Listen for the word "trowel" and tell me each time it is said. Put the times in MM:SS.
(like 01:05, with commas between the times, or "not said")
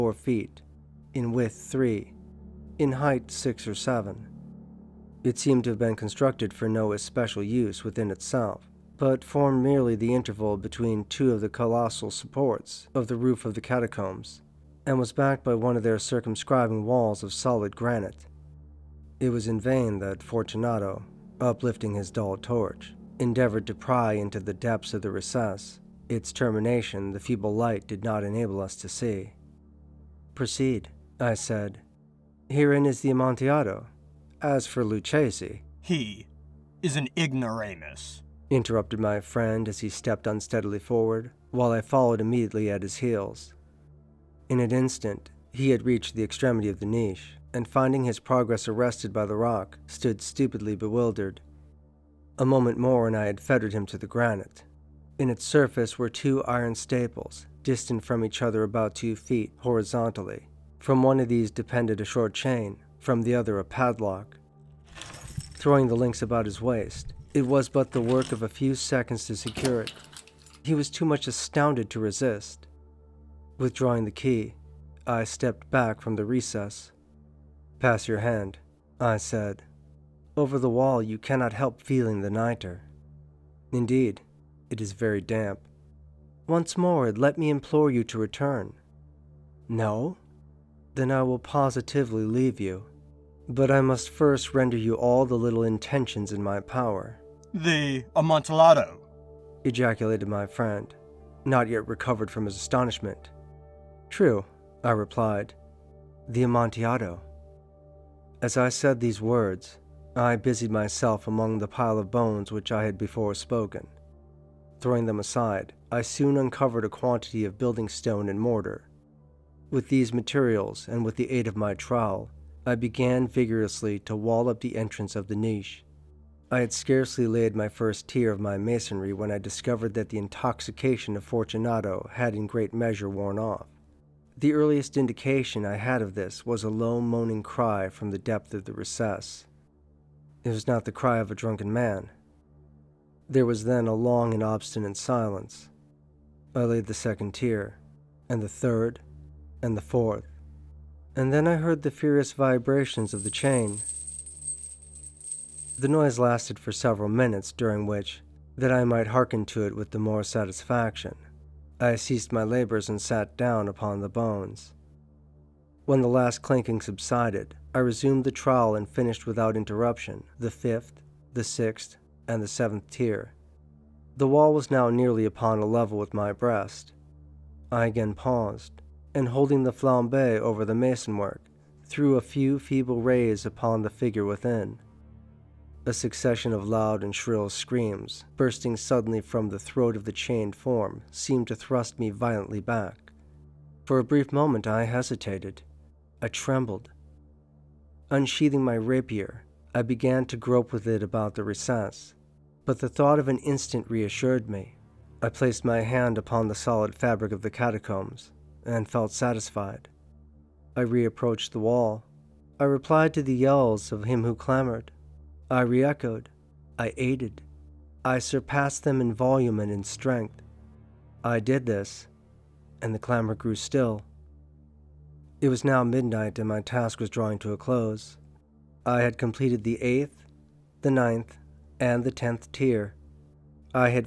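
02:01, 02:48.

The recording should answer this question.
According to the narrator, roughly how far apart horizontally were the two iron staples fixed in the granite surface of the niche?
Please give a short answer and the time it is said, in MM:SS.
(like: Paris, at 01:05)
2 feet, at 00:58.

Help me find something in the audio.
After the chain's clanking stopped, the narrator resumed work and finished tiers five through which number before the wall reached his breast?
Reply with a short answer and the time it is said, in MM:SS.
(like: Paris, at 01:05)
7, at 02:52.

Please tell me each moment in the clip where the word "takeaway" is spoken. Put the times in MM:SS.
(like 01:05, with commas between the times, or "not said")
not said.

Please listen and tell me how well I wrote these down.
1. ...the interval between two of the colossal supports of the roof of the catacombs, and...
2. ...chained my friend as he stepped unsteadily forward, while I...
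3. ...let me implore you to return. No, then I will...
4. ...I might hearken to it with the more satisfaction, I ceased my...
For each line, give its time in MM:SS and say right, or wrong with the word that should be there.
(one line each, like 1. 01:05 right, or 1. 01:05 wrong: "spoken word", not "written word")
1. 00:09 right
2. 00:38 wrong: "interrupted", not "chained"
3. 01:27 right
4. 02:38 right.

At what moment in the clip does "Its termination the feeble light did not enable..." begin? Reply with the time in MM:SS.
00:26.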